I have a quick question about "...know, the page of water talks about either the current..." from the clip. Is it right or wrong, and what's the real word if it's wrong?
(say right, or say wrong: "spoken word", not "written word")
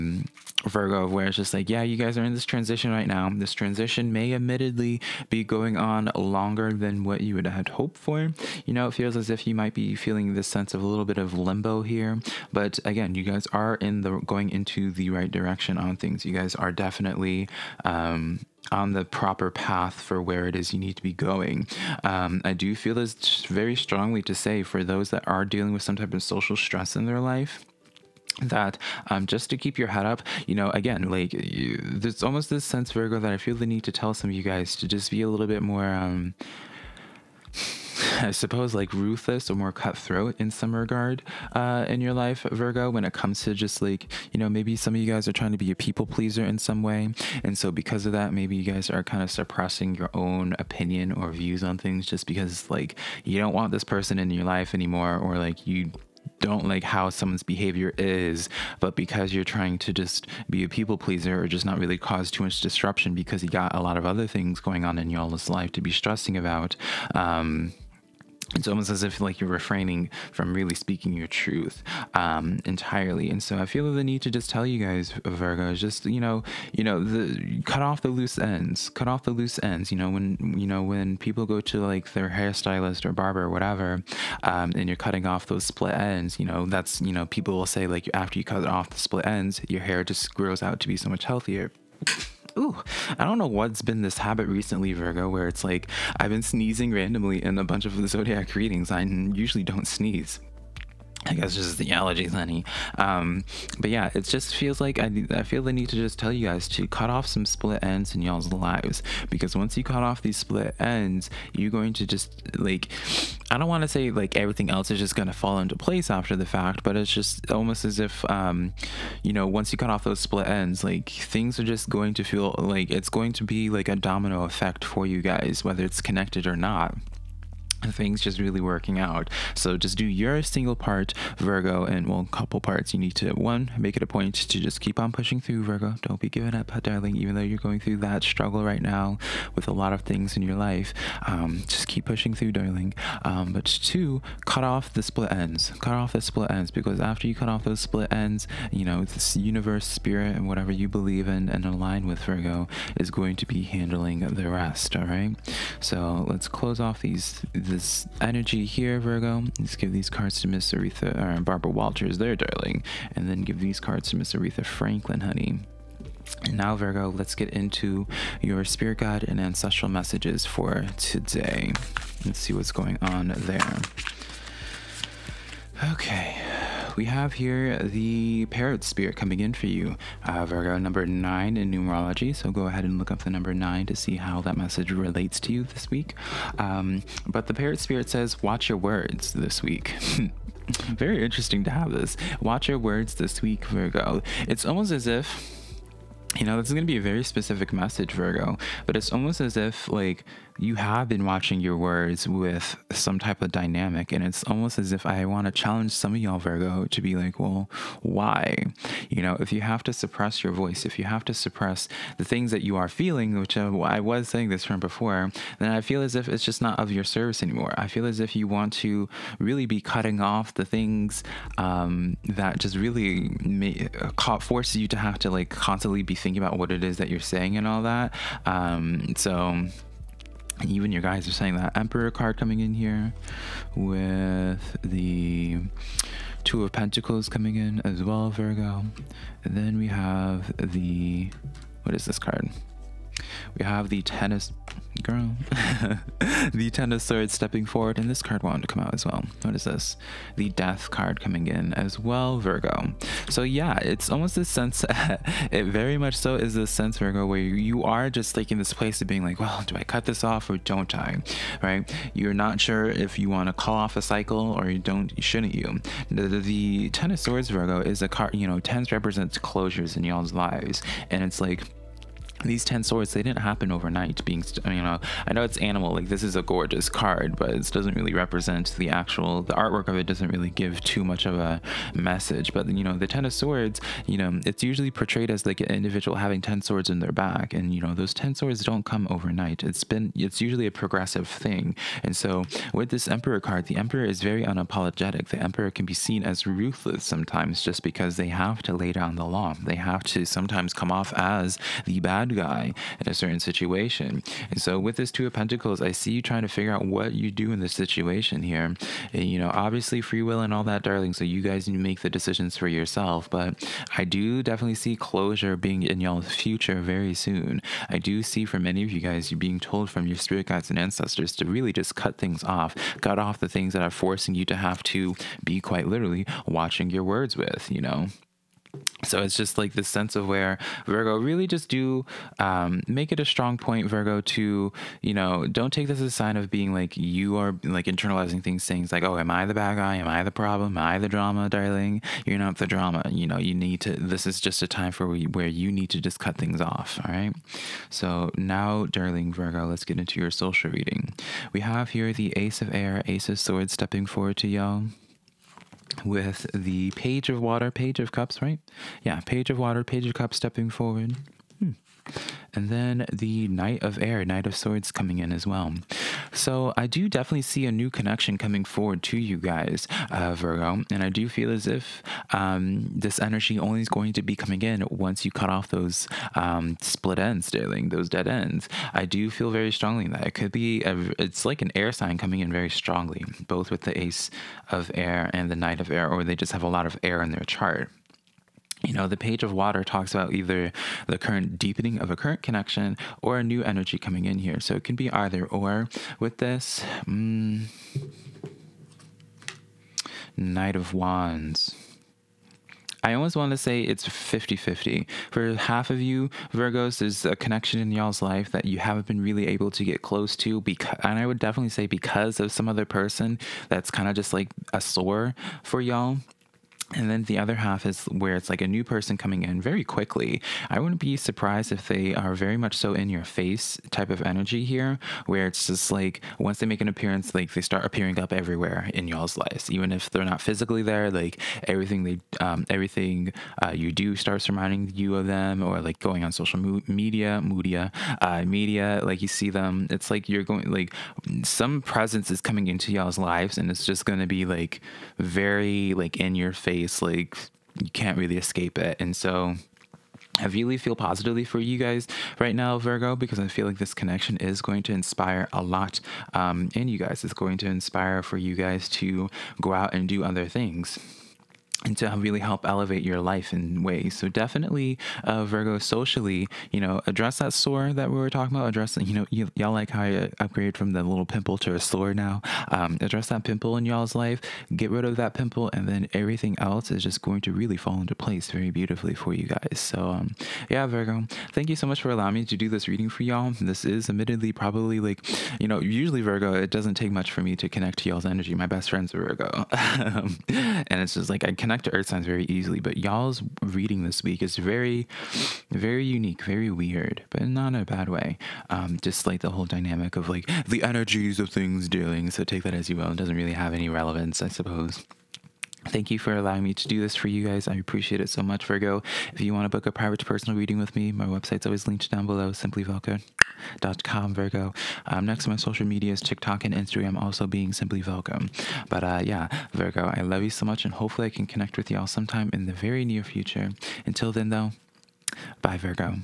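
right.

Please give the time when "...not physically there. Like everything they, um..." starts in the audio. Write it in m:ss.
7:10.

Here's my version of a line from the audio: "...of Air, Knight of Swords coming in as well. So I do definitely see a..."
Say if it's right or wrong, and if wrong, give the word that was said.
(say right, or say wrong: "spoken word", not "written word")
right.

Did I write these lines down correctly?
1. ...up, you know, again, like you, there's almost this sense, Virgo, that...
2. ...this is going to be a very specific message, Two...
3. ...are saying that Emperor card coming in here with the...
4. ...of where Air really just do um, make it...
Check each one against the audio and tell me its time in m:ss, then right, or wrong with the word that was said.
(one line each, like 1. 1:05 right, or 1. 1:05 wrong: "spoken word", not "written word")
1. 0:30 right
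2. 3:16 wrong: "Virgo", not "Two"
3. 3:51 right
4. 5:30 wrong: "Virgo", not "Air".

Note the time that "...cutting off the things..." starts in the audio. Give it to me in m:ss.
3:39.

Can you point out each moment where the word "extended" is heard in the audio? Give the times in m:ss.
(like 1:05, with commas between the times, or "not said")
not said.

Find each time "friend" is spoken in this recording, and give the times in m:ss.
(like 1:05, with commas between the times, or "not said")
8:08.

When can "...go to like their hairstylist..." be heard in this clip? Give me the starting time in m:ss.
1:21.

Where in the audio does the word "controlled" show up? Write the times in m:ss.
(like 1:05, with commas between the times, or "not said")
not said.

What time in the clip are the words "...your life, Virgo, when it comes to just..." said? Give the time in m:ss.
0:41.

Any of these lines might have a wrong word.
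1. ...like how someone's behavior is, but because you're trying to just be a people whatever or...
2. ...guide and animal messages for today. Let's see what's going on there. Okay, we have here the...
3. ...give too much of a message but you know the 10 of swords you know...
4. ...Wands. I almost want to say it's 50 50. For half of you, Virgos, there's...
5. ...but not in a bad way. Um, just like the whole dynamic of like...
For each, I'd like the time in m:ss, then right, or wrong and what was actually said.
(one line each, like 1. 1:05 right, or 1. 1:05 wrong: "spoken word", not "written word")
1. 0:56 wrong: "pleaser", not "whatever"
2. 2:48 wrong: "ancestral", not "animal"
3. 4:40 right
4. 6:40 right
5. 8:17 right.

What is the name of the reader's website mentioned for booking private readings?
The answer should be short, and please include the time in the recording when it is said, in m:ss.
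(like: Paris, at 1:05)
Simply Velca, at 8:32.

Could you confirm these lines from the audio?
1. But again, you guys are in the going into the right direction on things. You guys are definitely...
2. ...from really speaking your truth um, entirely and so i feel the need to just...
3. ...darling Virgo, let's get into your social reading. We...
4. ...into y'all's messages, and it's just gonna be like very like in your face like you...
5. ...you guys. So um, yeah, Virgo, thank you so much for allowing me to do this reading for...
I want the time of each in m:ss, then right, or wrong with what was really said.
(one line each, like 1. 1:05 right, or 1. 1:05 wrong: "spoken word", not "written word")
1. 0:12 right
2. 1:10 right
3. 5:48 right
4. 7:22 wrong: "lives", not "messages"
5. 7:59 right.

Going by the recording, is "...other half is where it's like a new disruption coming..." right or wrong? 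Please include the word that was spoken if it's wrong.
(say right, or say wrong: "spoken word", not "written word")
wrong: "person", not "disruption".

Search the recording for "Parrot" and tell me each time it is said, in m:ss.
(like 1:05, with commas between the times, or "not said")
2:58, 3:07.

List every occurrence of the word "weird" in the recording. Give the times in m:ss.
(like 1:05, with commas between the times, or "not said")
8:16.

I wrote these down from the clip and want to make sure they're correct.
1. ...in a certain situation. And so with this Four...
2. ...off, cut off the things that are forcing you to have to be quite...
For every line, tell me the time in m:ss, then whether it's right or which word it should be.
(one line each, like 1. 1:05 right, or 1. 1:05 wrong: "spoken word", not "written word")
1. 5:02 wrong: "Two", not "Four"
2. 5:22 right.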